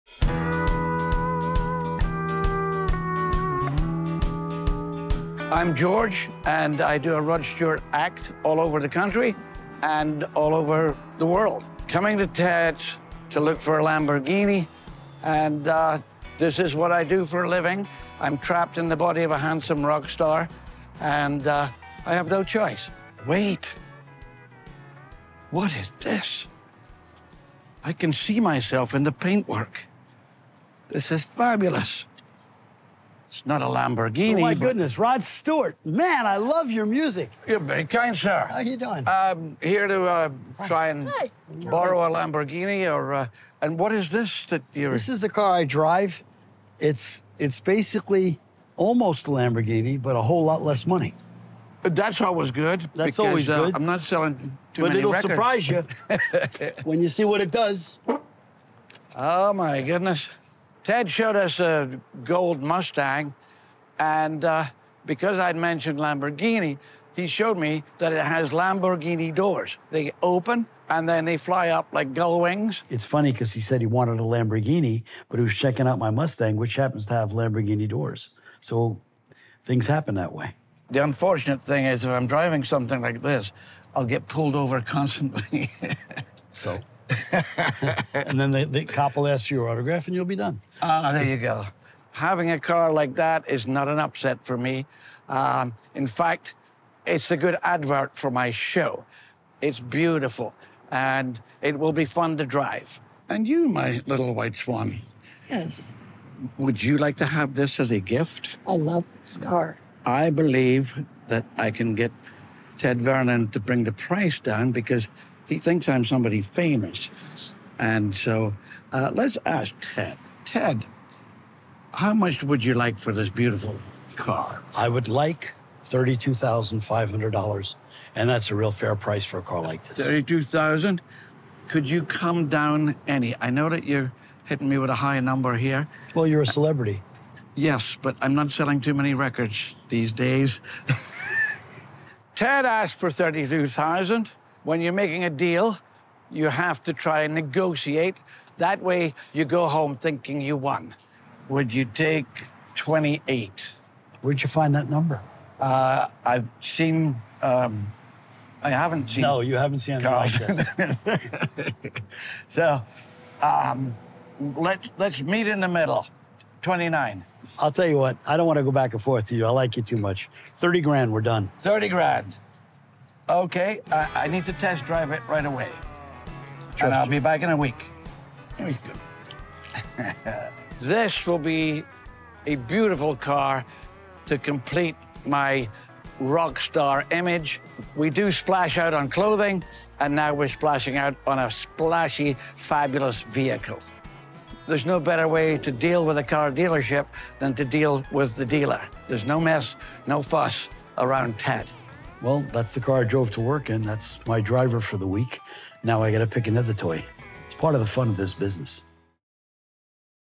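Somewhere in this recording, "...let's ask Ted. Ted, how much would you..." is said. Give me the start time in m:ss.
1:59.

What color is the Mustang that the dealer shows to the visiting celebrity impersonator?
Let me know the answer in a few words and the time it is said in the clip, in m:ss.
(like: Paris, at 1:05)
Gold, at 1:02.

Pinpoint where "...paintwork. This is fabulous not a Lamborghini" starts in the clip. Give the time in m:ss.
0:29.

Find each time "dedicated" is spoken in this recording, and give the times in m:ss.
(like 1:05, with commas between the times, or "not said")
not said.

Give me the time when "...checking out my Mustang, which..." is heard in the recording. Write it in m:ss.
1:15.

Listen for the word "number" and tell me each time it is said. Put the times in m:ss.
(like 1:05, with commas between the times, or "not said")
2:15, 2:34.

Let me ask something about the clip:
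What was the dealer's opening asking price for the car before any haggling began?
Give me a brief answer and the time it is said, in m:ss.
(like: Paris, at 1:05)
$32,500, at 2:05.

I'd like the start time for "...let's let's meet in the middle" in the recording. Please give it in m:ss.
2:44.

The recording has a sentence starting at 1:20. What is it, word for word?
The unfortunate thing is, if I'm driving something like this, I'll get pulled over constantly.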